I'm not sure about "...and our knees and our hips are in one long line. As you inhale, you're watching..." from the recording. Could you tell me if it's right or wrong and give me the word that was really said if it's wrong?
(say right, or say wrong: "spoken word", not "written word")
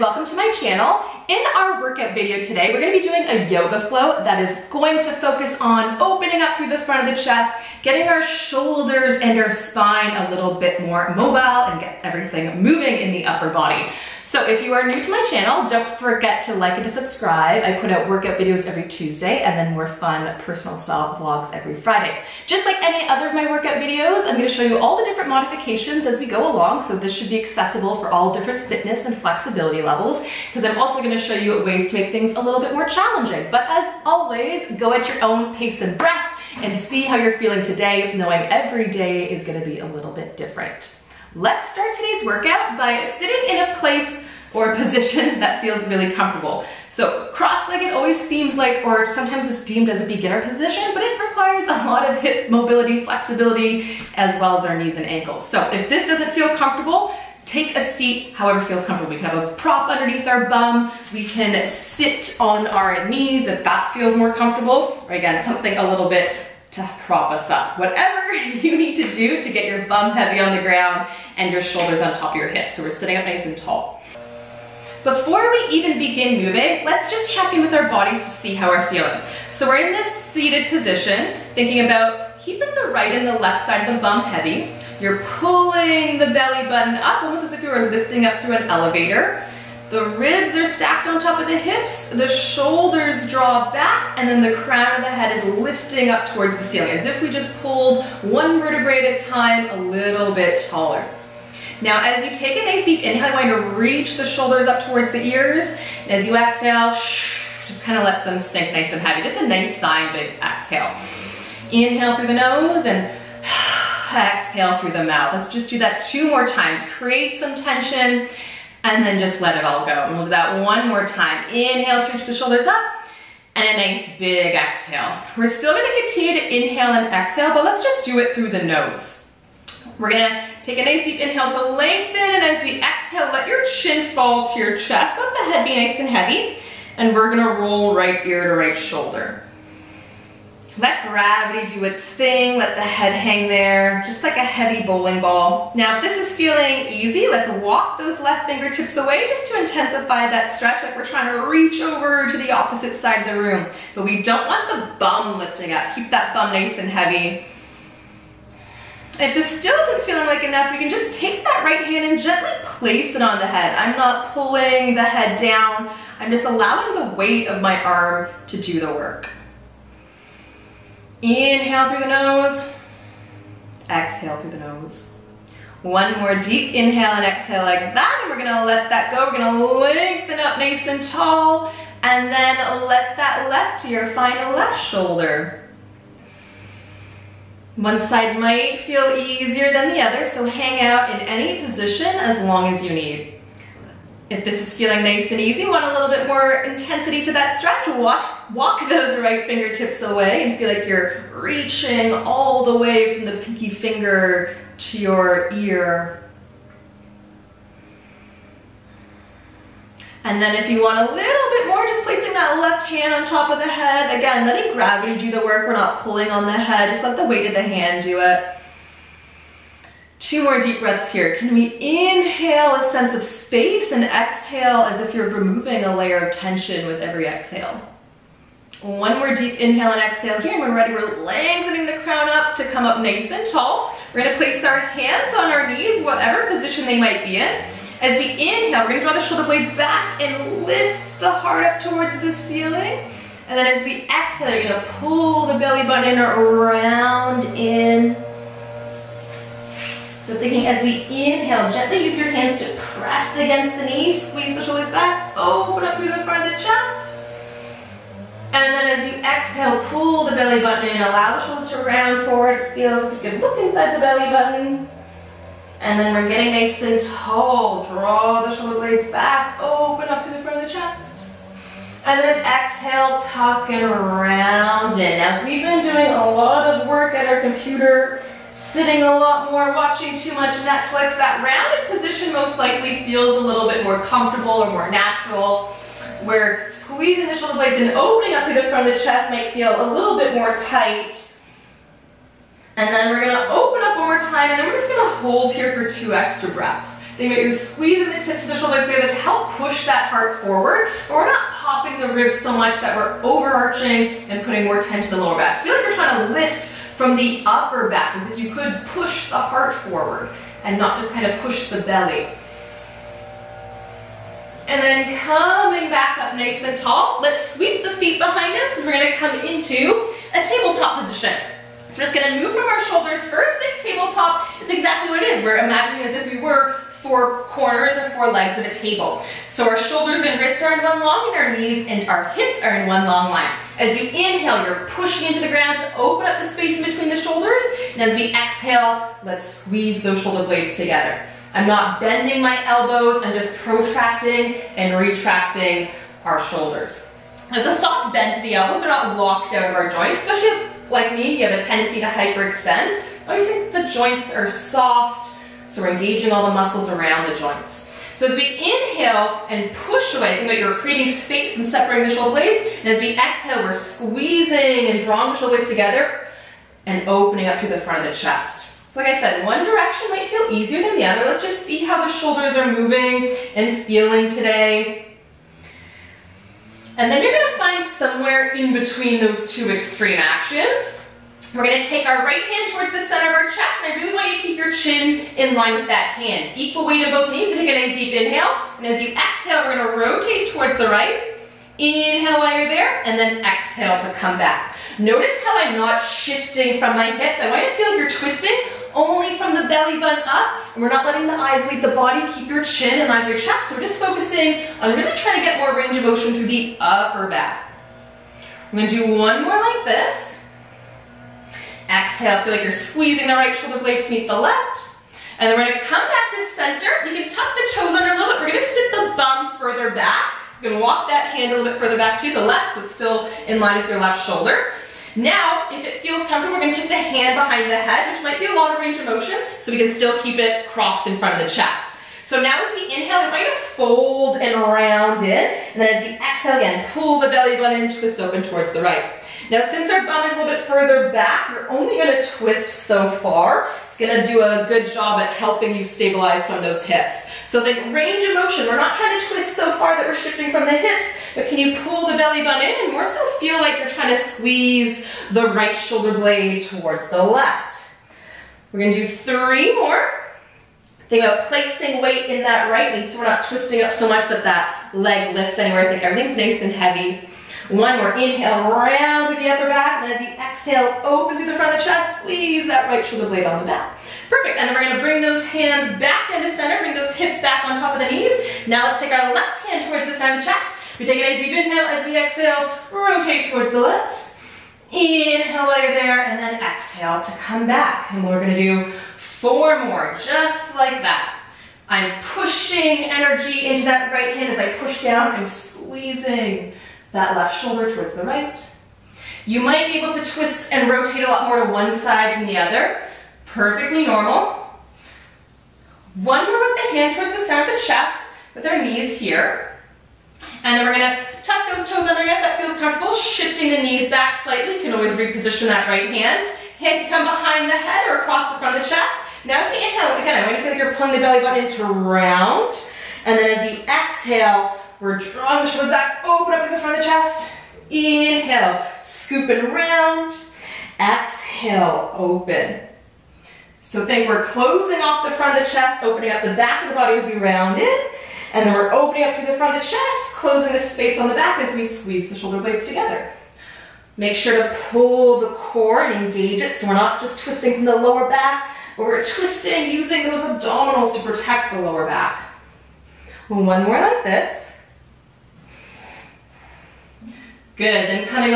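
wrong: "pushing", not "watching".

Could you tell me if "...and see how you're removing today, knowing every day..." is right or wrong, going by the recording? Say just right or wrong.
wrong.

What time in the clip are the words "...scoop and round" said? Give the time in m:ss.
8:49.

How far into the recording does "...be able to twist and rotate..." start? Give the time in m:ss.
8:19.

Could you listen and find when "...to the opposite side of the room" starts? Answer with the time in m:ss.
2:32.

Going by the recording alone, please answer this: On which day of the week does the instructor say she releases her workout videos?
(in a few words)
Tuesday.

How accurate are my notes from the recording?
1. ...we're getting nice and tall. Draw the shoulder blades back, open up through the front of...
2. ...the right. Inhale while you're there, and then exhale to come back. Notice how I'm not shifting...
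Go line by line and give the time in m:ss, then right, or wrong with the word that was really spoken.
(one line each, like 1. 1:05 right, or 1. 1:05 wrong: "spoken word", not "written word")
1. 4:26 right
2. 6:30 right.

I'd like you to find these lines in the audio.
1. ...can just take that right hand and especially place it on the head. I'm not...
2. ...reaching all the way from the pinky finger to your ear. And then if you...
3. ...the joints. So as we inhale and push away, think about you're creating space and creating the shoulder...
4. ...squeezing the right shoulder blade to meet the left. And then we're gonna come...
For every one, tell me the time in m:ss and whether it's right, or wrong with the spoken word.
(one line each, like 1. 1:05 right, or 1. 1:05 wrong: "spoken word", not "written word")
1. 2:40 wrong: "gently", not "especially"
2. 3:21 right
3. 5:57 wrong: "separating", not "creating"
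4. 6:52 right.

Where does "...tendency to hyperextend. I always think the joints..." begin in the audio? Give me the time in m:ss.
5:51.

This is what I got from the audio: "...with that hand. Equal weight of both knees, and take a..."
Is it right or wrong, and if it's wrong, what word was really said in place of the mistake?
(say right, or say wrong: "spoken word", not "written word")
right.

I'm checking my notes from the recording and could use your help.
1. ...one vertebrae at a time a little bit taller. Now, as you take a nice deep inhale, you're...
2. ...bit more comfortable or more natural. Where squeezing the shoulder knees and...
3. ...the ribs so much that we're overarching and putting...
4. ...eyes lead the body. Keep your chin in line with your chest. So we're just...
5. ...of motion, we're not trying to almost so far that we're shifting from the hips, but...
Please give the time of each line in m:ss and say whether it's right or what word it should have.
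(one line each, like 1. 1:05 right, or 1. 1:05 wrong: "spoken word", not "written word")
1. 1:38 right
2. 4:43 wrong: "blades", not "knees"
3. 5:01 right
4. 6:41 right
5. 7:28 wrong: "twist", not "almost".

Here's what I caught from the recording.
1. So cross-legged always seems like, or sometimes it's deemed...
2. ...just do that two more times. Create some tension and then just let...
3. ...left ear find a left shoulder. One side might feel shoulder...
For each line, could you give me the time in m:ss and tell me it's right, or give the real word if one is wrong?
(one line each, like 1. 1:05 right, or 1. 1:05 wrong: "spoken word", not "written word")
1. 0:46 right
2. 1:55 right
3. 3:03 wrong: "easier", not "shoulder".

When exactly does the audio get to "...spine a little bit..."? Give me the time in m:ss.
0:09.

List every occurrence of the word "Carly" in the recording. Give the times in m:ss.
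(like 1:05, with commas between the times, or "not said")
not said.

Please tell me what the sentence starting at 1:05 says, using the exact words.
Or again, something a little bit to prop us up.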